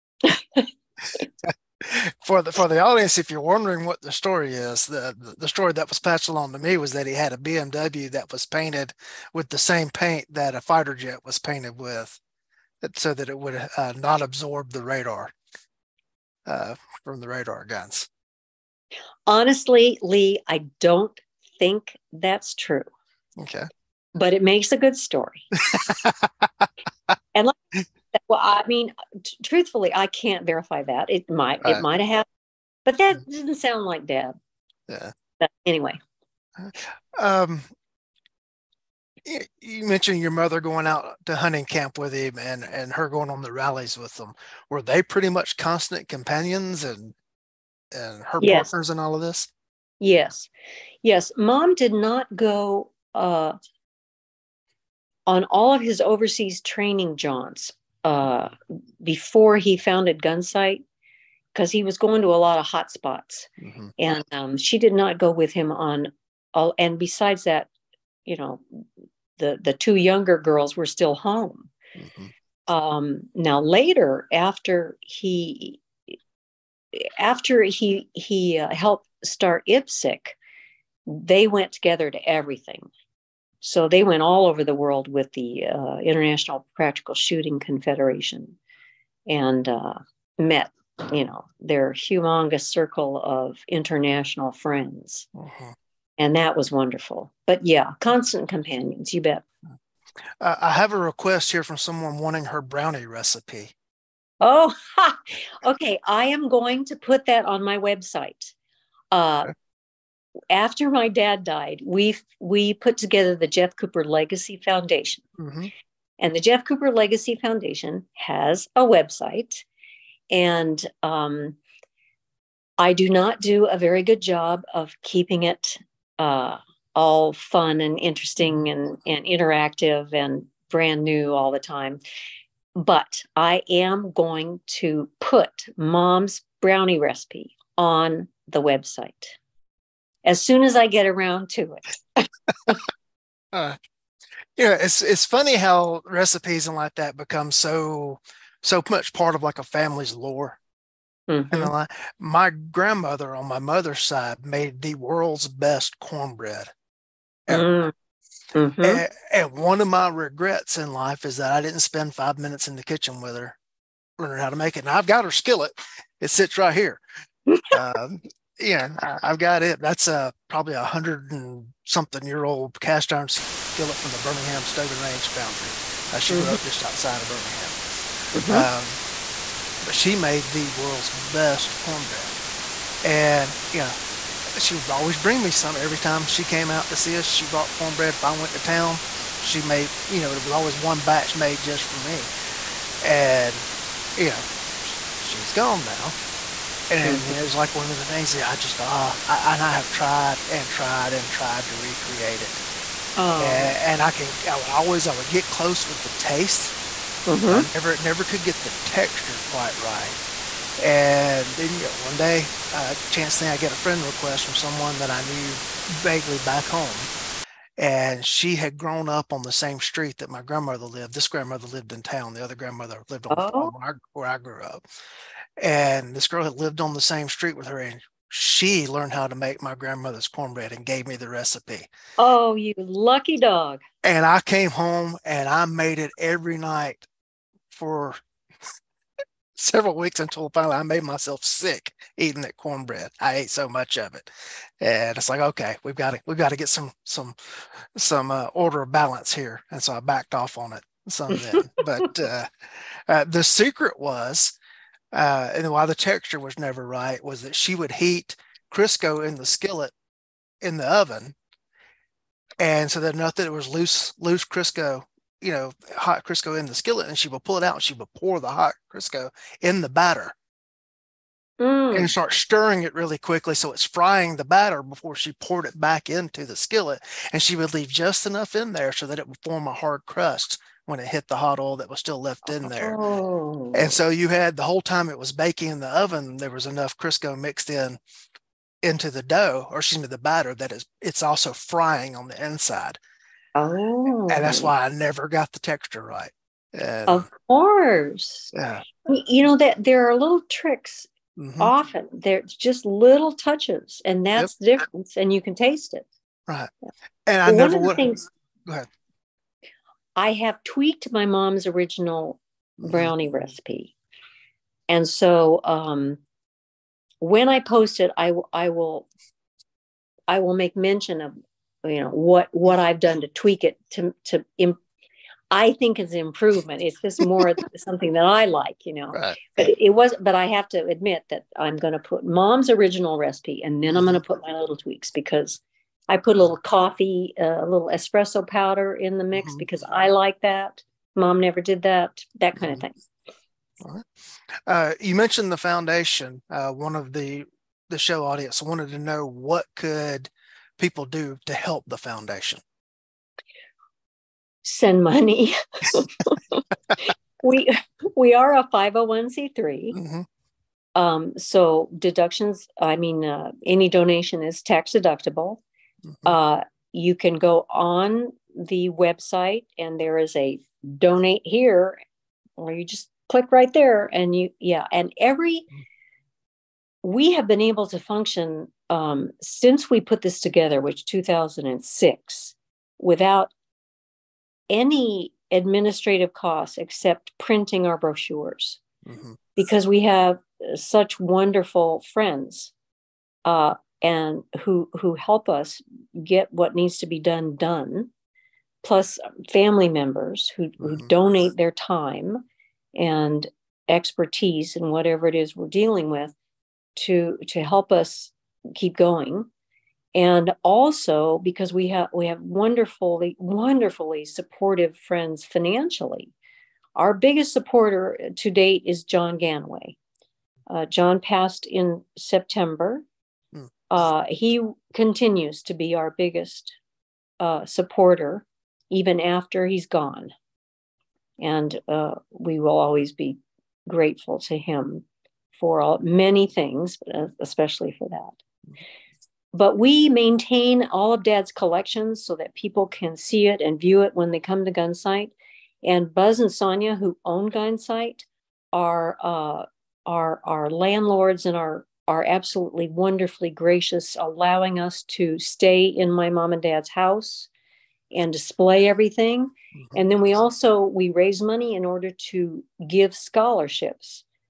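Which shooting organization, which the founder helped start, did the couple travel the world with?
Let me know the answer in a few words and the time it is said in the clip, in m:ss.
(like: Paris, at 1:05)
International Practical Shooting Confederation, at 1:25.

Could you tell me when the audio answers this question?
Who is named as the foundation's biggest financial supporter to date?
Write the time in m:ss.
6:59.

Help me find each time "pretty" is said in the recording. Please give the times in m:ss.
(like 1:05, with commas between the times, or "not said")
0:45.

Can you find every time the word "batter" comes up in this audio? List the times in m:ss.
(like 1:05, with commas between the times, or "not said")
4:29, 4:34, 4:50.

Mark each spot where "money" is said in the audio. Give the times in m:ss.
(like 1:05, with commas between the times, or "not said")
5:55, 7:41.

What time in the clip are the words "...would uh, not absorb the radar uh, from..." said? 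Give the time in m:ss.
0:13.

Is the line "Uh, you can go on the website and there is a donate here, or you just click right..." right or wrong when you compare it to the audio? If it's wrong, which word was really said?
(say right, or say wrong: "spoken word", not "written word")
right.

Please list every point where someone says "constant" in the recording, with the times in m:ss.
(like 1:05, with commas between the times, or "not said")
0:45, 1:38.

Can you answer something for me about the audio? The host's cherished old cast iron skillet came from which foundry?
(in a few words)
Birmingham Stove and Range Foundry.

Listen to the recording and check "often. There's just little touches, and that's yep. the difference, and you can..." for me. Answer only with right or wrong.
right.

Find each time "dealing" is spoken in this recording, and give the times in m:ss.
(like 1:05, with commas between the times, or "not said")
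6:45.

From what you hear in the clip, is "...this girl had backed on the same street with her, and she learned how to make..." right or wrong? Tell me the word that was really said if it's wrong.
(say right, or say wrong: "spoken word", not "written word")
wrong: "lived", not "backed".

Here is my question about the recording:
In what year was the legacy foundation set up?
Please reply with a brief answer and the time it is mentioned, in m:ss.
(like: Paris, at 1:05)
2006, at 6:21.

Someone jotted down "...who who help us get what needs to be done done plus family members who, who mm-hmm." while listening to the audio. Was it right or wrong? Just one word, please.
right.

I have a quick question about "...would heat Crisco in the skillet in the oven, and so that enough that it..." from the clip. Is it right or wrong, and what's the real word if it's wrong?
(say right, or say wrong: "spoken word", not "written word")
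right.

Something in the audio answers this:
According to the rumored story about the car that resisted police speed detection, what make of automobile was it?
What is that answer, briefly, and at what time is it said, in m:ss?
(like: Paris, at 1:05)
BMW, at 0:07.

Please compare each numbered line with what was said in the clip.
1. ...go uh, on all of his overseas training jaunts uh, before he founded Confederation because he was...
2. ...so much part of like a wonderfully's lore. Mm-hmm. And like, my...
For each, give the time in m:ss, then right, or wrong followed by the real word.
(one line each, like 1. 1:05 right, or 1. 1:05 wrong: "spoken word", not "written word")
1. 0:52 wrong: "Gunsite", not "Confederation"
2. 2:28 wrong: "family", not "wonderfully".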